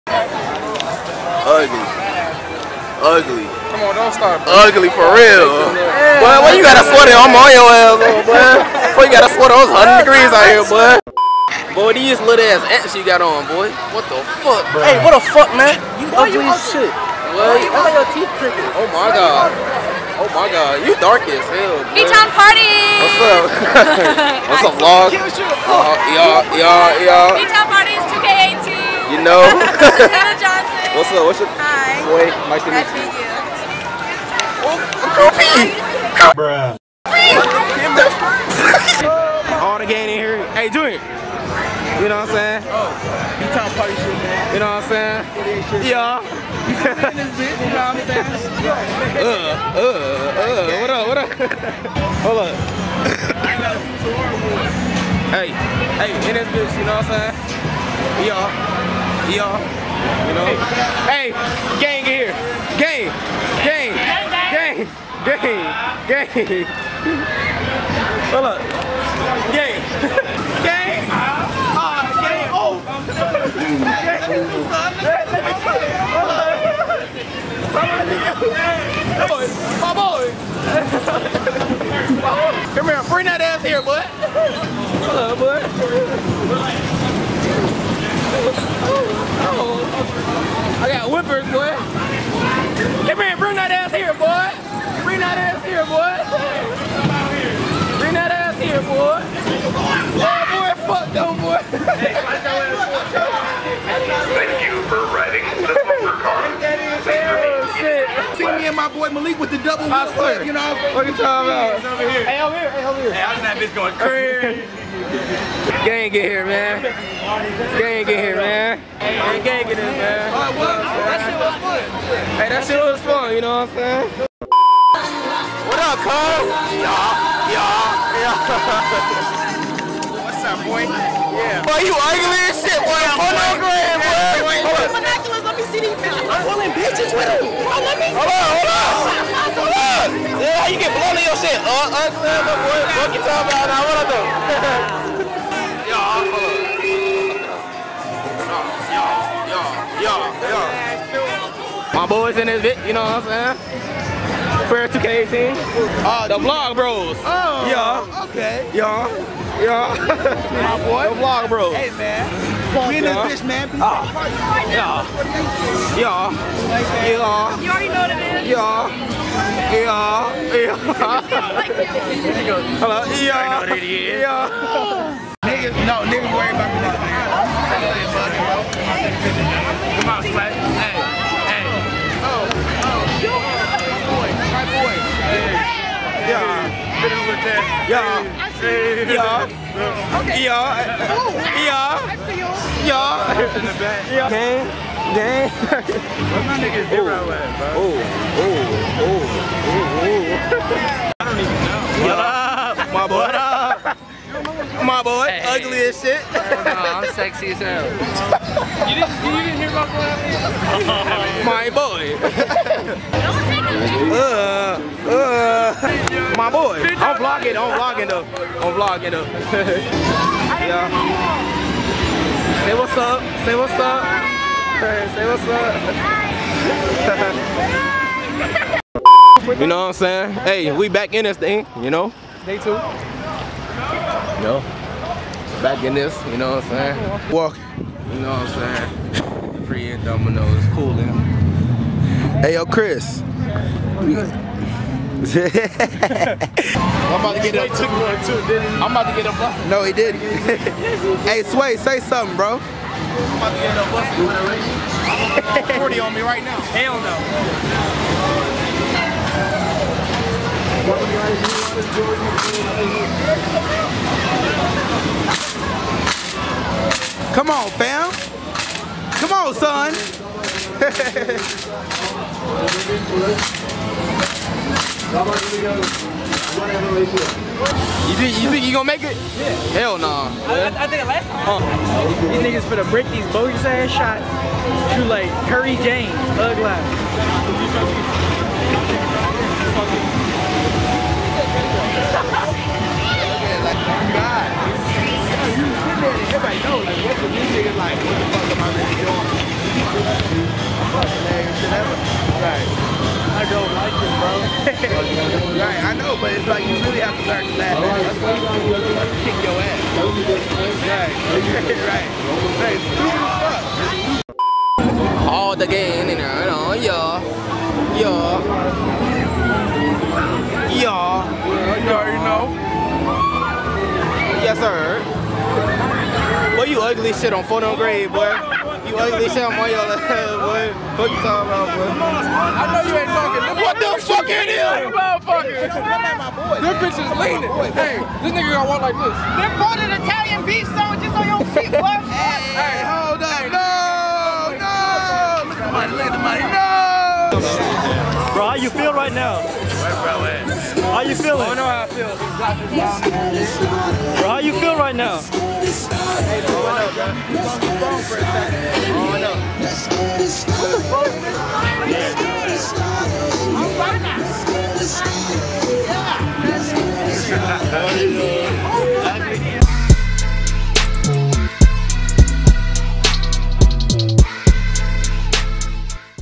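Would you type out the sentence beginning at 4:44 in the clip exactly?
Shoot like Curry James, Ugly life.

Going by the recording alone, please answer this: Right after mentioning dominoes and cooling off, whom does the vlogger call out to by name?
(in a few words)
Chris.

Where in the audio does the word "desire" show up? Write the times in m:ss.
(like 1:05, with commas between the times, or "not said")
not said.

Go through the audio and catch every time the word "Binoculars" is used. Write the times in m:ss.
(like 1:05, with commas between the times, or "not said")
2:14.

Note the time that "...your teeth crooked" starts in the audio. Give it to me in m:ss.
0:17.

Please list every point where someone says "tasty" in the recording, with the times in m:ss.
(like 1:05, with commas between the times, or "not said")
not said.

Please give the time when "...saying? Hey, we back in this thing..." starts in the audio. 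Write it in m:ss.
3:49.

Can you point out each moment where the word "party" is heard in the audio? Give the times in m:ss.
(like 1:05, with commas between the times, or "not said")
0:22, 0:27, 0:43.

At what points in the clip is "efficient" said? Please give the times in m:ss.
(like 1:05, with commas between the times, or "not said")
not said.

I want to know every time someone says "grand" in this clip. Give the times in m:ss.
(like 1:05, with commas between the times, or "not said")
2:13.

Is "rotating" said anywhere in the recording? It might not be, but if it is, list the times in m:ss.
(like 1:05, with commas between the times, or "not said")
not said.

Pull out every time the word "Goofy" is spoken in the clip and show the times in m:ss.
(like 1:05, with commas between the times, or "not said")
0:35.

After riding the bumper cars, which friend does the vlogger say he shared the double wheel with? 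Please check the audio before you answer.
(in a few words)
Malik.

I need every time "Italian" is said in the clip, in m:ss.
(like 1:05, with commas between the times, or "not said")
5:40.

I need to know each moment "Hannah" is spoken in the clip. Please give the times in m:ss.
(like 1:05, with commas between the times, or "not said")
0:29.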